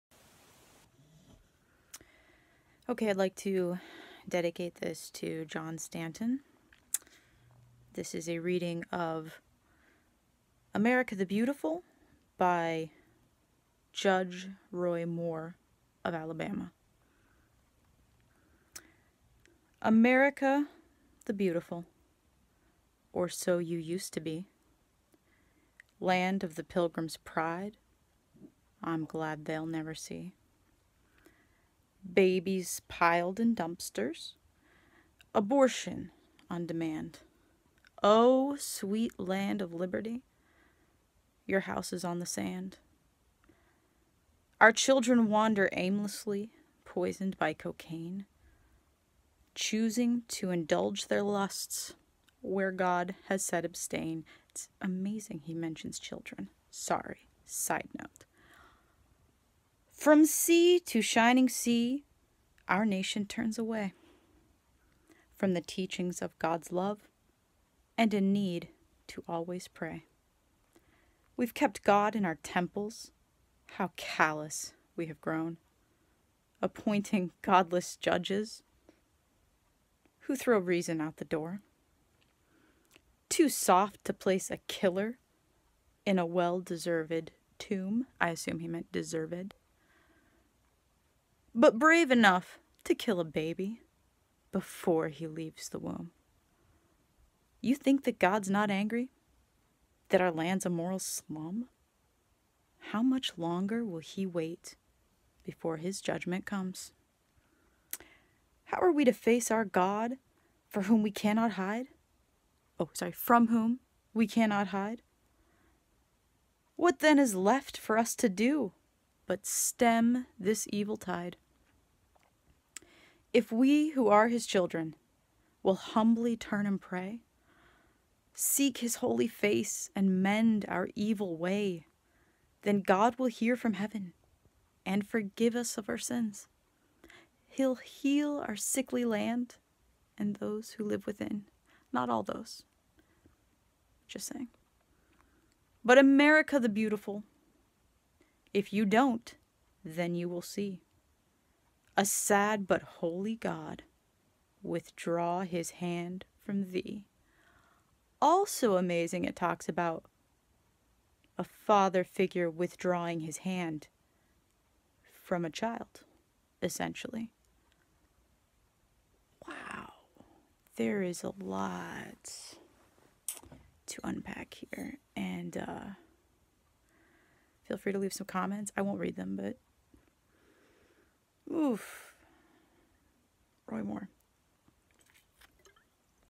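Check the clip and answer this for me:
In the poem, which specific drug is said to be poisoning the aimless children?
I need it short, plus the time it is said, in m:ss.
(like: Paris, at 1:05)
Cocaine, at 0:47.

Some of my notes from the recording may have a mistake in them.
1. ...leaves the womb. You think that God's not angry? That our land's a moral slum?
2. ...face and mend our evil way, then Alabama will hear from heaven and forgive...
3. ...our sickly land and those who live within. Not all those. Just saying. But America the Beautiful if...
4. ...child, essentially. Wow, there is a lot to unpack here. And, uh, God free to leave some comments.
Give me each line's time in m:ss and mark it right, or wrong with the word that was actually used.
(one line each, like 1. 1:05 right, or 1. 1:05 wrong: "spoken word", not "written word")
1. 1:35 right
2. 2:09 wrong: "God", not "Alabama"
3. 2:18 right
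4. 2:45 wrong: "Feel", not "God".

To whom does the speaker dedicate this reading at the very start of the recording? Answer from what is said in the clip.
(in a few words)
John Stanton.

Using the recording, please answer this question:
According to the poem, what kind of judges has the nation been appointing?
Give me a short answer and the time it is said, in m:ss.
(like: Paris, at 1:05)
Godless judges, at 1:17.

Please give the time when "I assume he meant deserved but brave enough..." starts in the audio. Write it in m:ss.
1:28.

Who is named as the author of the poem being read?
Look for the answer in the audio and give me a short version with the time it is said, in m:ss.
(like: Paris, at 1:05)
Judge Roy Moore, at 0:13.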